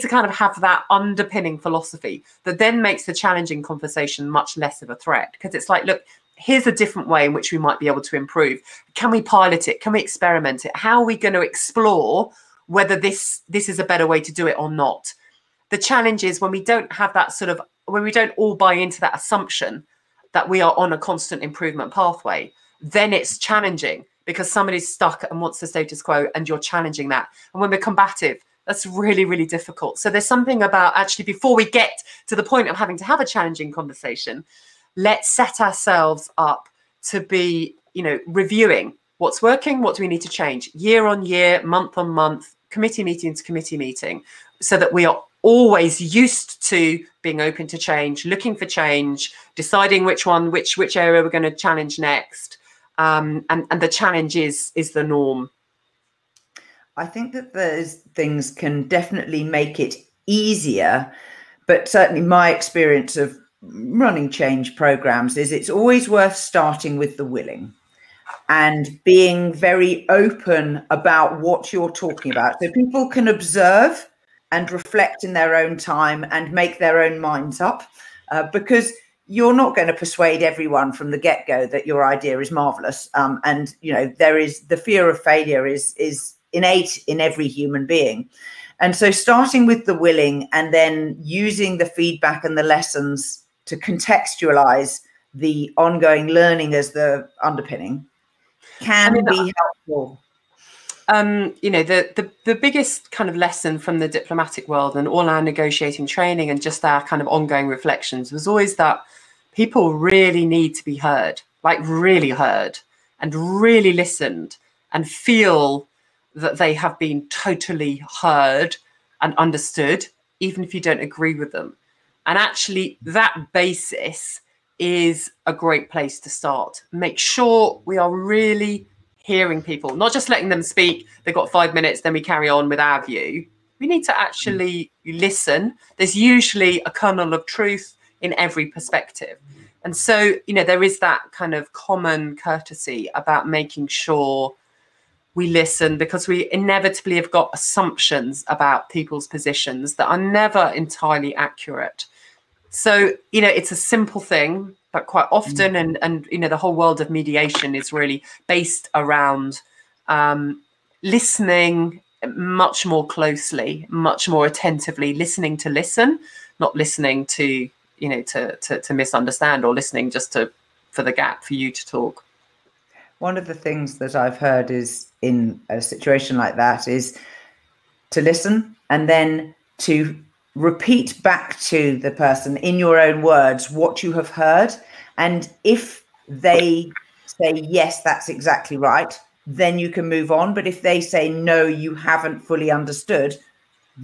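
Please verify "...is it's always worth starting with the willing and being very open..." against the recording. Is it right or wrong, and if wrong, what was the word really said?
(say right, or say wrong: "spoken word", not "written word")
right.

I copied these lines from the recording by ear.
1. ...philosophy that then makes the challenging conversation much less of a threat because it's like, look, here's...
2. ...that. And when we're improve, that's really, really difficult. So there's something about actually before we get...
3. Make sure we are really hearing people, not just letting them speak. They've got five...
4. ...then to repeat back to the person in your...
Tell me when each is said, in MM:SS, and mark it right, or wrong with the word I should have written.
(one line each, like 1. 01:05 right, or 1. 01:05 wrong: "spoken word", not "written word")
1. 00:01 right
2. 00:27 wrong: "combative", not "improve"
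3. 02:06 right
4. 02:59 right.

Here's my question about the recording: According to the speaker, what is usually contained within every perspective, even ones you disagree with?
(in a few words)
kernel of truth.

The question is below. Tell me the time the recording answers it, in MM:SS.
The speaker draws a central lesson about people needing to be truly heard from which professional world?
01:44.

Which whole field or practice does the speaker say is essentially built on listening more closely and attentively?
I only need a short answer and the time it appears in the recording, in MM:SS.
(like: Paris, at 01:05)
mediation, at 02:37.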